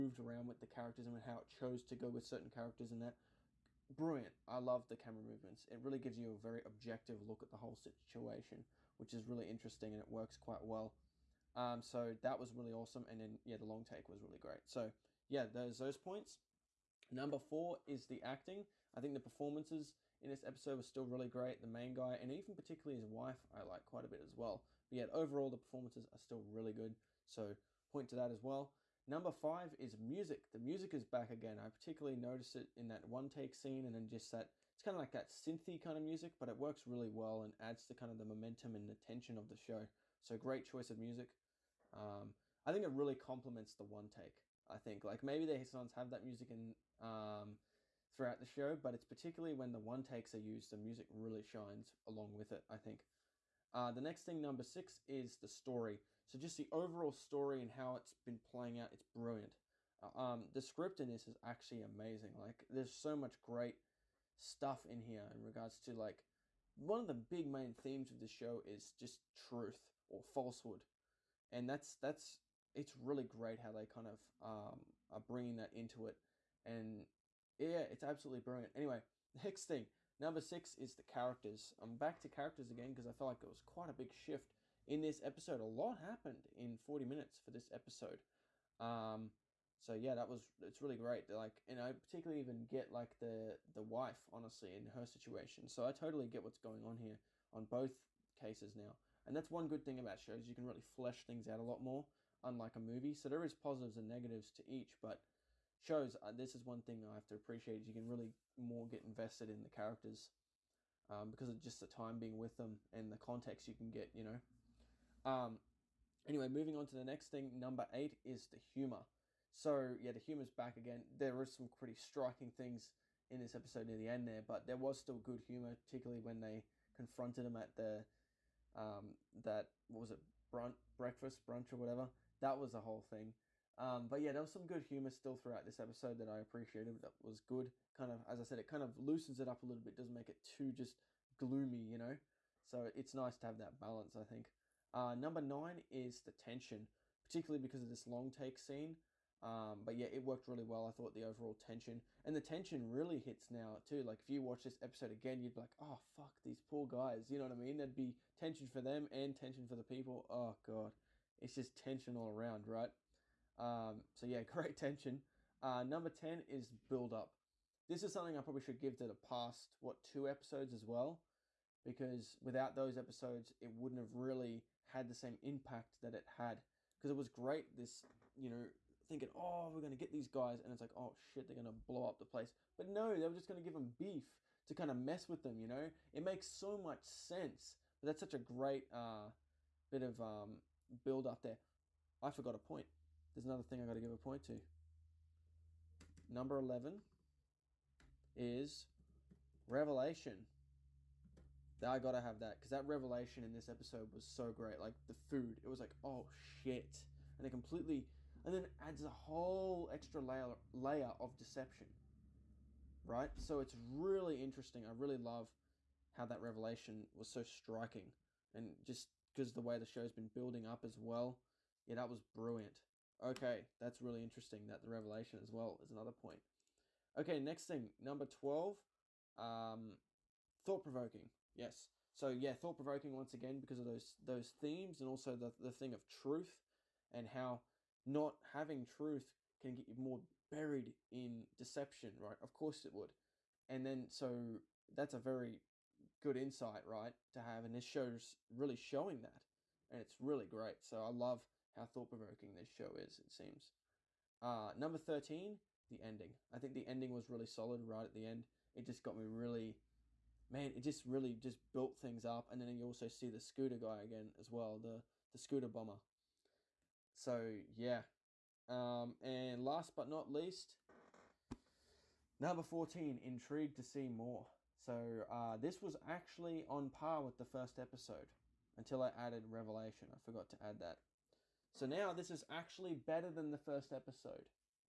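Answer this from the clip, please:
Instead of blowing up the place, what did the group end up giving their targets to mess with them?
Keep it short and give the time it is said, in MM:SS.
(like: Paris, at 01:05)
Beef, at 03:03.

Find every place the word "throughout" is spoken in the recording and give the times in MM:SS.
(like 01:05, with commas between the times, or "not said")
00:48, 02:15.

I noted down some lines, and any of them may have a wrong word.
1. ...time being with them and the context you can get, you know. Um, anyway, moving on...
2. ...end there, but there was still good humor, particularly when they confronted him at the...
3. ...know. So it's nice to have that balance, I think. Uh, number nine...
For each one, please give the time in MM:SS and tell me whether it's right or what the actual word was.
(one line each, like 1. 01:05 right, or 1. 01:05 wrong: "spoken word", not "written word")
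1. 01:51 right
2. 02:04 right
3. 02:21 right.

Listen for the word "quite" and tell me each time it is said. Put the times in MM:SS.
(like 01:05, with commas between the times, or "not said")
00:10, 00:23, 01:23.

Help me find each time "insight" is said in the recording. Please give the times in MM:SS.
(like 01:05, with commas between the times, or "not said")
04:06.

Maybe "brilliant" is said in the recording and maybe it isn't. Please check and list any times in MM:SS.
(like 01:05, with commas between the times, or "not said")
00:03, 00:59, 01:18, 03:42.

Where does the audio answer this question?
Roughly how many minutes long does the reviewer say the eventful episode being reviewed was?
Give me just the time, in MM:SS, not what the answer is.
01:26.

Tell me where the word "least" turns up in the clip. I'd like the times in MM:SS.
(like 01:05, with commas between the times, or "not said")
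04:30.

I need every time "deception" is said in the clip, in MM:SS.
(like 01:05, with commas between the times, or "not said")
03:31, 04:01.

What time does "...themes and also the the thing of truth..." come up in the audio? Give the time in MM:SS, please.
03:54.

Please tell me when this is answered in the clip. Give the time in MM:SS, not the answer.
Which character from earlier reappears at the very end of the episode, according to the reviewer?
04:25.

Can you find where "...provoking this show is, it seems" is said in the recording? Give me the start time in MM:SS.
04:12.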